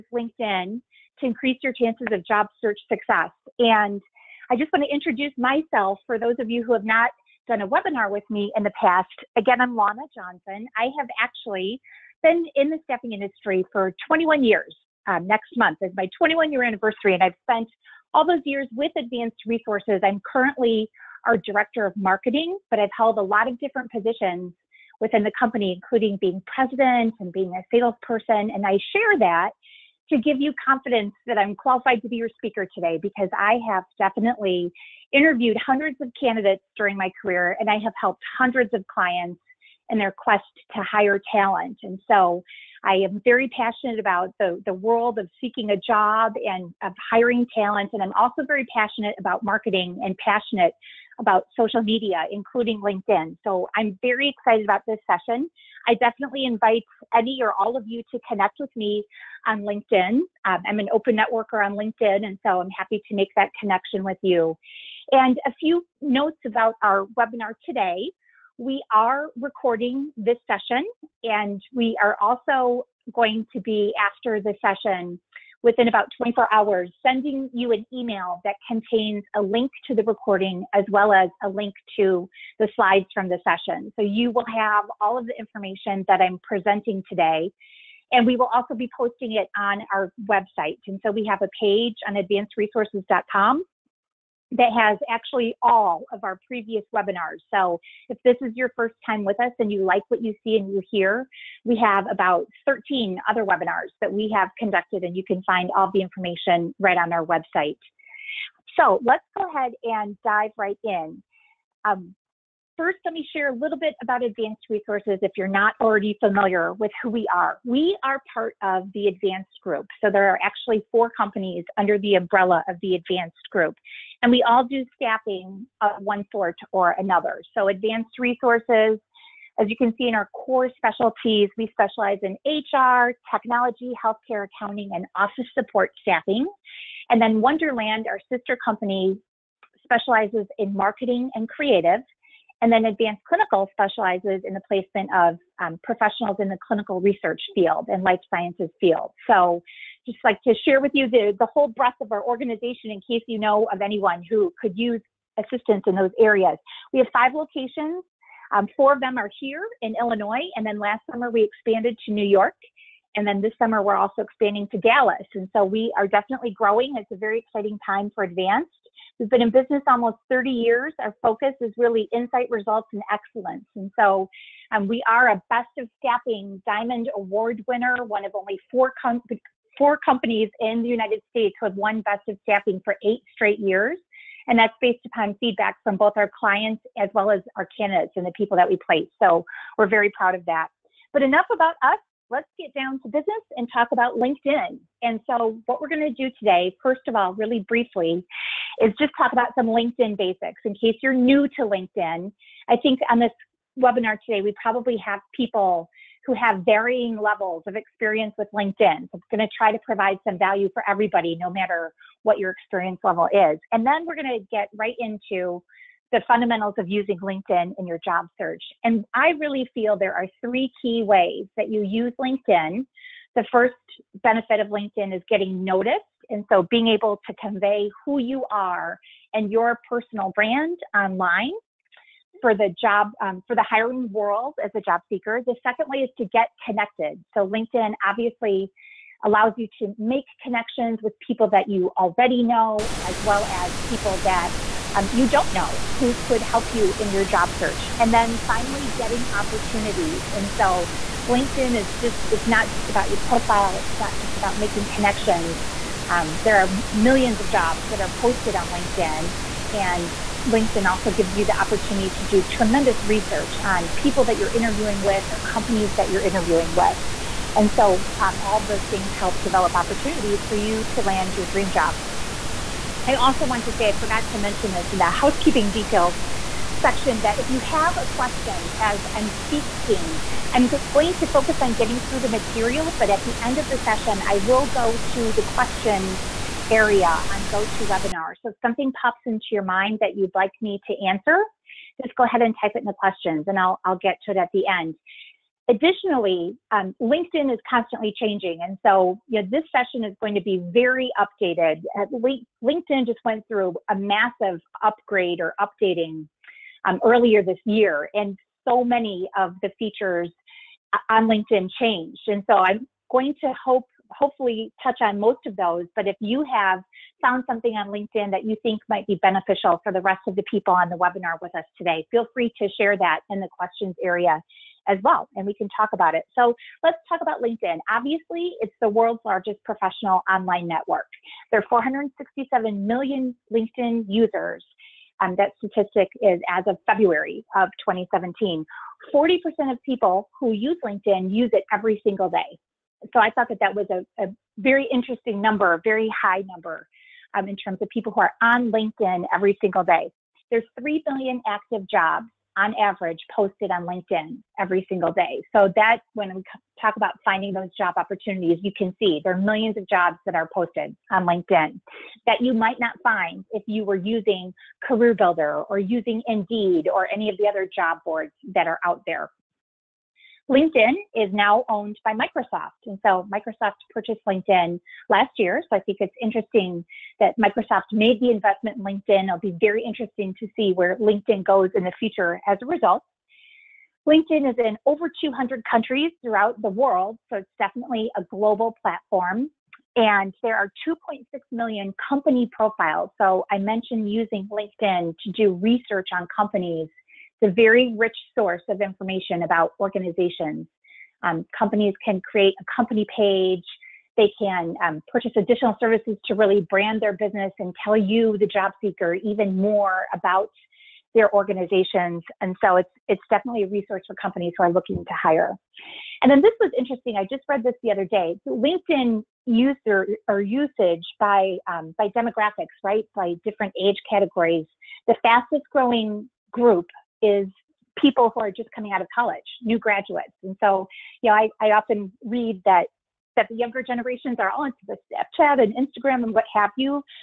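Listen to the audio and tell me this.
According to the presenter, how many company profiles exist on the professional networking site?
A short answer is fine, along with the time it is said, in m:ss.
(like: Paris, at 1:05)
2.6 million, at 6:30.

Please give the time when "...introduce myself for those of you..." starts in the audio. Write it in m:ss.
0:04.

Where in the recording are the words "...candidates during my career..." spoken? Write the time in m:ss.
0:36.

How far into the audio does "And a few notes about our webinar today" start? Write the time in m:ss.
1:05.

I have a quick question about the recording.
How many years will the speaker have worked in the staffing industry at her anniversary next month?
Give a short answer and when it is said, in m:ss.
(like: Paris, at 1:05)
21, at 0:14.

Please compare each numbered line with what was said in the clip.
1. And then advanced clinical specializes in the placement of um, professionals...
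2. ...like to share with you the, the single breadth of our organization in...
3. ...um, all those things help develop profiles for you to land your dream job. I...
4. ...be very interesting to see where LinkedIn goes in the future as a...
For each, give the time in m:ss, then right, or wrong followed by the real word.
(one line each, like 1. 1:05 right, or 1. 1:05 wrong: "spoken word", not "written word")
1. 2:22 right
2. 2:30 wrong: "whole", not "single"
3. 4:28 wrong: "opportunities", not "profiles"
4. 6:19 right.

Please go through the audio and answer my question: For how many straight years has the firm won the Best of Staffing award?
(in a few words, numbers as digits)
8.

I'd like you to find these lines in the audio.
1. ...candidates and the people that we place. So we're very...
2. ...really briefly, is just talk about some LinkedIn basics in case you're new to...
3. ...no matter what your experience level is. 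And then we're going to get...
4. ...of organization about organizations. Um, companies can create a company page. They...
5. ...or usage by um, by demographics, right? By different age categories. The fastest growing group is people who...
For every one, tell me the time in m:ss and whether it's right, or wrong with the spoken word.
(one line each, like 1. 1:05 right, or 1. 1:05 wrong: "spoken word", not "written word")
1. 3:07 right
2. 3:17 right
3. 3:31 right
4. 6:38 wrong: "information", not "organization"
5. 7:00 right.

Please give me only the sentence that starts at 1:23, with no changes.
So you will have all of the information that I'm presenting today.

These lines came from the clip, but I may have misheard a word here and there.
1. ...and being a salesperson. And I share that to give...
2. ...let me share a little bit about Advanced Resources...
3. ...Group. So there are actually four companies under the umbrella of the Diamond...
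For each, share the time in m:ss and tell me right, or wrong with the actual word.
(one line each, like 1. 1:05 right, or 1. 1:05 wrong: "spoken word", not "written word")
1. 0:27 right
2. 1:53 right
3. 1:59 wrong: "Advanced", not "Diamond".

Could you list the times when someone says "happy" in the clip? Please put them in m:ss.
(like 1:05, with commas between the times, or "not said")
1:02.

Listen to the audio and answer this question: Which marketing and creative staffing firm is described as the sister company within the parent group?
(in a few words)
Wonderland.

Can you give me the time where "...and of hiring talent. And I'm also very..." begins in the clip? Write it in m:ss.
0:46.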